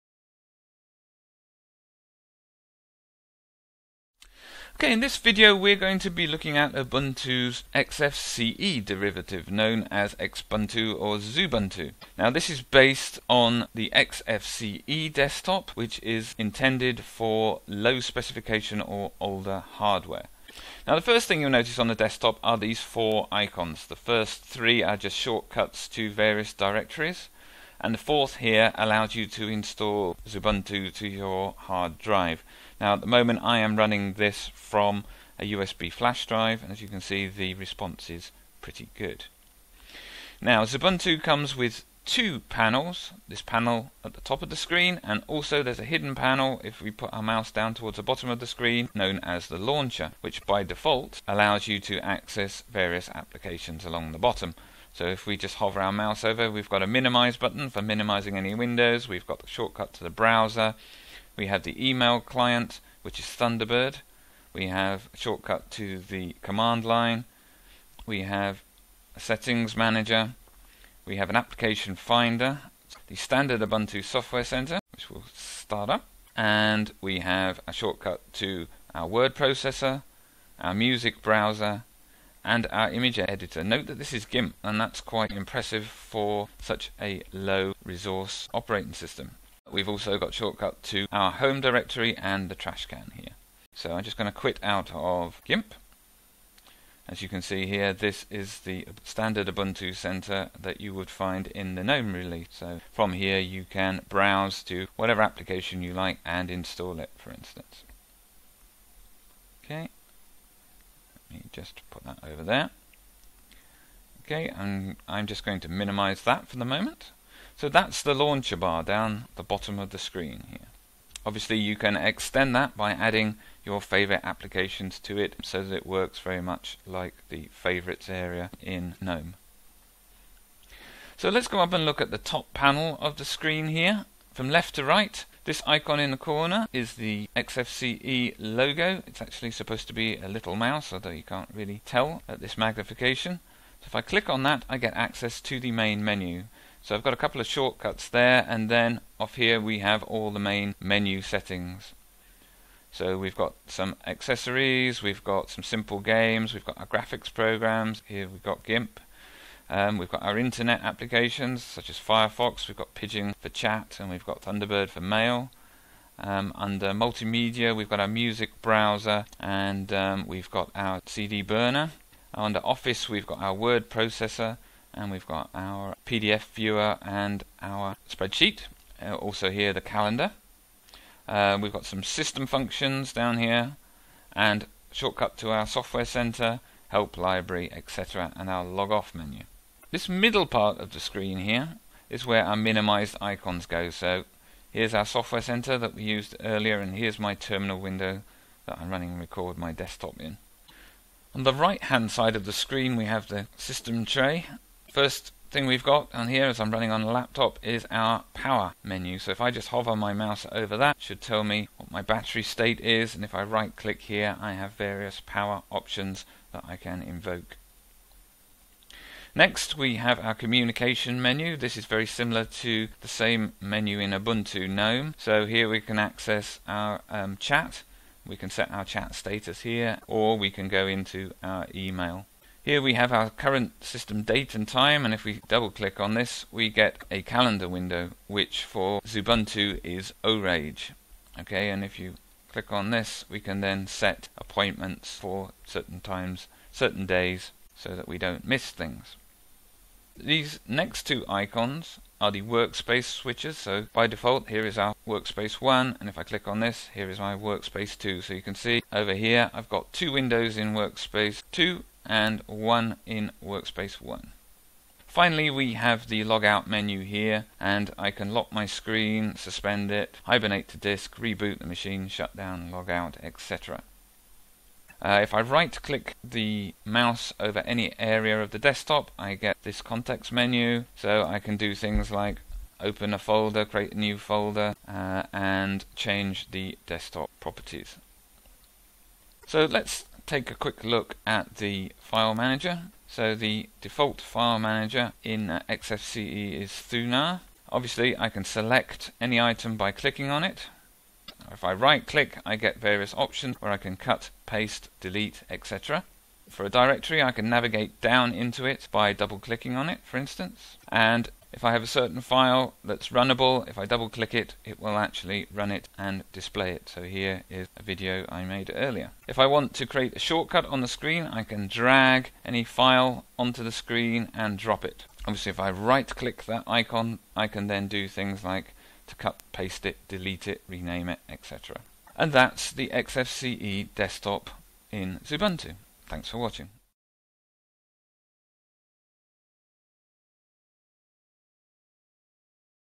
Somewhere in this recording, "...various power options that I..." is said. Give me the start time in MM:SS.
03:34.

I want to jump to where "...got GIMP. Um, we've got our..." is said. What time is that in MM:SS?
02:38.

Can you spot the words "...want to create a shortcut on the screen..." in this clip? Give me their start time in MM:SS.
05:19.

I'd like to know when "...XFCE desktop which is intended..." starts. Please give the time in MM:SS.
00:13.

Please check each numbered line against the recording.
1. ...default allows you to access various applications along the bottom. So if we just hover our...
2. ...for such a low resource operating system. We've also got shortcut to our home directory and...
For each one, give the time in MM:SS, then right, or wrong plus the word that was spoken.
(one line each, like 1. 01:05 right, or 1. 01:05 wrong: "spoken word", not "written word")
1. 00:50 right
2. 01:25 right.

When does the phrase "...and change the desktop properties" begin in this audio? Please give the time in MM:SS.
04:45.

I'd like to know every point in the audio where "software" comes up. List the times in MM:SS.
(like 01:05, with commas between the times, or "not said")
01:14, 03:05, 03:15.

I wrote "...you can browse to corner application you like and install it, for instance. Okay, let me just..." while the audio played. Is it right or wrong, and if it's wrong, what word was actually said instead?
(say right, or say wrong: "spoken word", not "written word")
wrong: "whatever", not "corner".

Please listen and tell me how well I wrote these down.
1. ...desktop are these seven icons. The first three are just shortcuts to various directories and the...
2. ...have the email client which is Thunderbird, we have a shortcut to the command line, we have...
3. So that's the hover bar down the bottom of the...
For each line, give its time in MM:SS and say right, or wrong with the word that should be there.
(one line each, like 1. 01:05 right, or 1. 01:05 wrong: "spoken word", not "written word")
1. 00:21 wrong: "four", not "seven"
2. 01:01 right
3. 01:57 wrong: "launcher", not "hover".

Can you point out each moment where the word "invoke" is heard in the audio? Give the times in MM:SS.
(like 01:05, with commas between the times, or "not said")
03:37.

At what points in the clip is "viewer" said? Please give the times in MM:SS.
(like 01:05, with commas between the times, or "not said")
02:56.